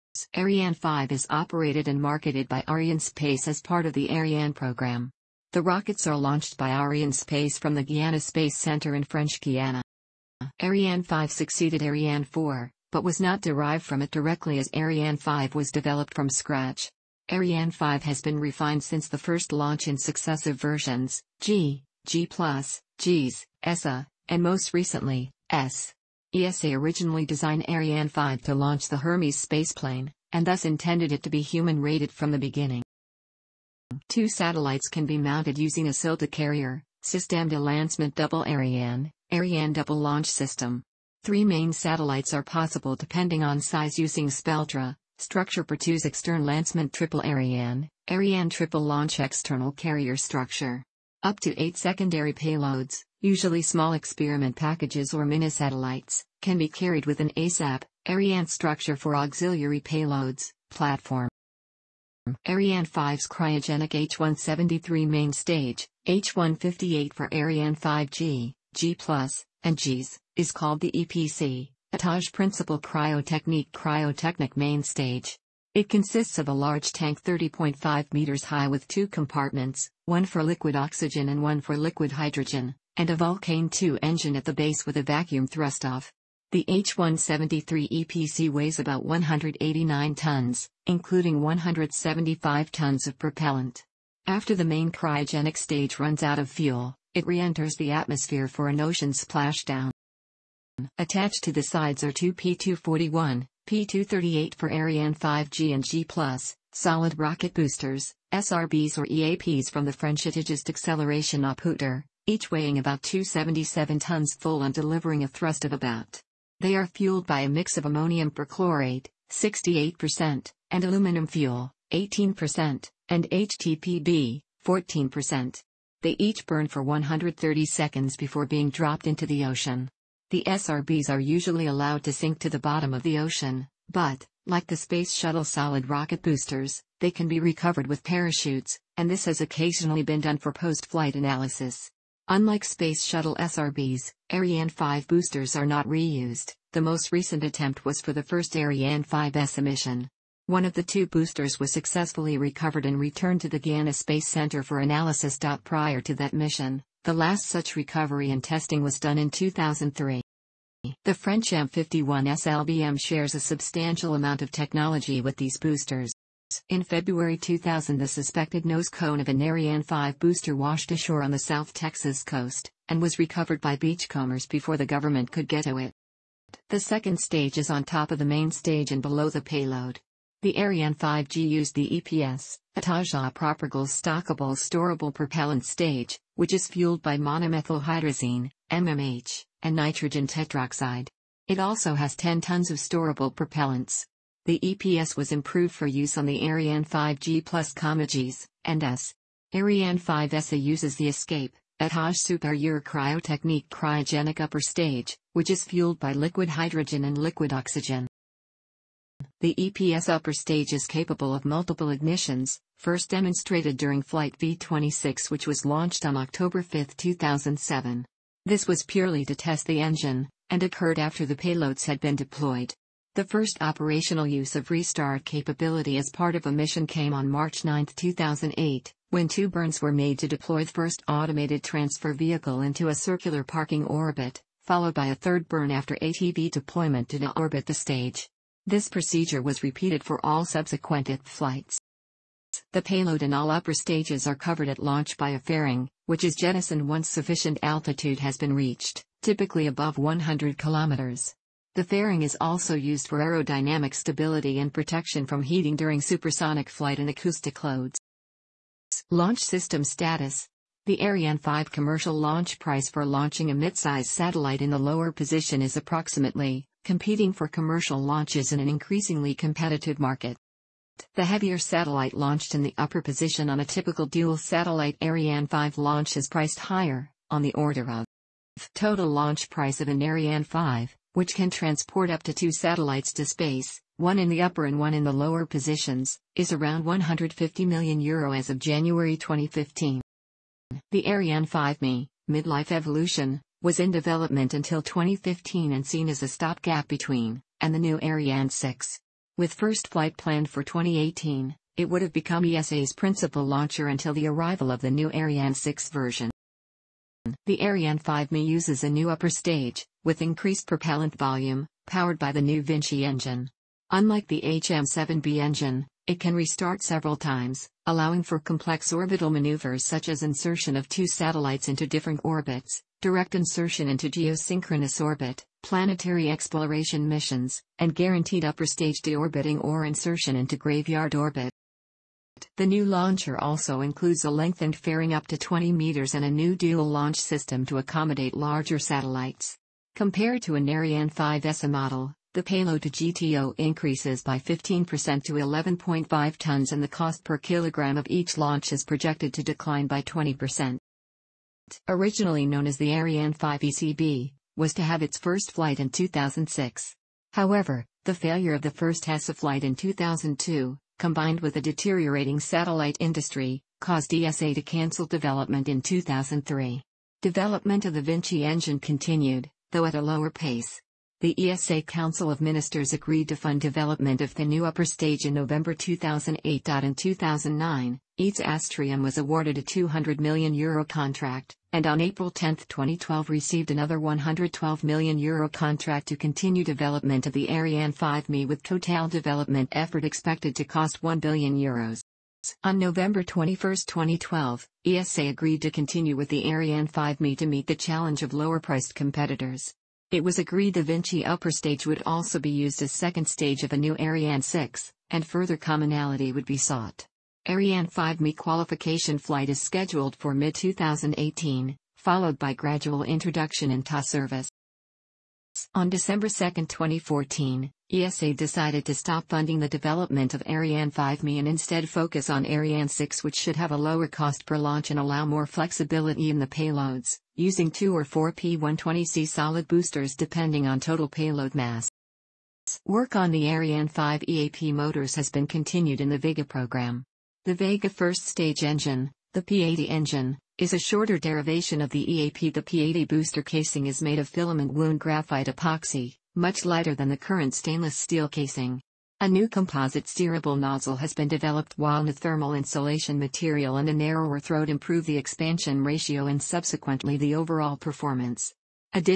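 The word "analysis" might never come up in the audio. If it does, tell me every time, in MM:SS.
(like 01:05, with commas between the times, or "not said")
02:21, 02:34.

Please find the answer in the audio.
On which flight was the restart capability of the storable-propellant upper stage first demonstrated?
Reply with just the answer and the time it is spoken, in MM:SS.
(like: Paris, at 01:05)
V-26, at 03:34.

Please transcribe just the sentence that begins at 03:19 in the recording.
Ariane 5SA uses the Escape, Etage Superior Cryotechnique cryogenic upper stage, which is fueled by liquid hydrogen and liquid oxygen.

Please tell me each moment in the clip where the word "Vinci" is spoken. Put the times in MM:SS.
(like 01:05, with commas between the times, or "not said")
05:12, 06:08, 06:40.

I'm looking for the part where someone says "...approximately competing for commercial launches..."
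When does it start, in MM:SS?
04:25.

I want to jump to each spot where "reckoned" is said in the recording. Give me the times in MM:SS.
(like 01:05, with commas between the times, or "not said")
not said.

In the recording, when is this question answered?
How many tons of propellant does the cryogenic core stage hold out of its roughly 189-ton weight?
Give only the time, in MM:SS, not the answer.
01:31.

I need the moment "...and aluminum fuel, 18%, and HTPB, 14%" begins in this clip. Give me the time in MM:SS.
02:00.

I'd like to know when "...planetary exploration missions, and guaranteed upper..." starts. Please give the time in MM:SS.
05:25.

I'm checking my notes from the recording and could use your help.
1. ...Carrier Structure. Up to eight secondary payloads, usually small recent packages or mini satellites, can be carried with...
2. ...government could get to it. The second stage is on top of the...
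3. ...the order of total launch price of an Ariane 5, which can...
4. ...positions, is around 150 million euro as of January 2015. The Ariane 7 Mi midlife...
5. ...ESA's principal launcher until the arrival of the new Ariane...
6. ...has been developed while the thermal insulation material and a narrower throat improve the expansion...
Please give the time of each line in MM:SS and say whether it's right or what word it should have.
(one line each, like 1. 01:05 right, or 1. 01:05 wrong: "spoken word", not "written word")
1. 00:49 wrong: "experiment", not "recent"
2. 02:54 right
3. 04:37 right
4. 04:45 wrong: "5", not "7"
5. 05:02 right
6. 07:30 right.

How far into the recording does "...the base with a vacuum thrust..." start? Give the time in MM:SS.
01:24.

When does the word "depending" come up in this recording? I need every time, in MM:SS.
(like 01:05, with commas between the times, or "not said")
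00:42, 07:10.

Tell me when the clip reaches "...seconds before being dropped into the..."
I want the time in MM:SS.
02:07.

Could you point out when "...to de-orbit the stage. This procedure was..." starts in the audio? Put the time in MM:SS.
03:57.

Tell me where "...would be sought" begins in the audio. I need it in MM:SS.
06:46.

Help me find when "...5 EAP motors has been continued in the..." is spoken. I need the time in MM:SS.
07:13.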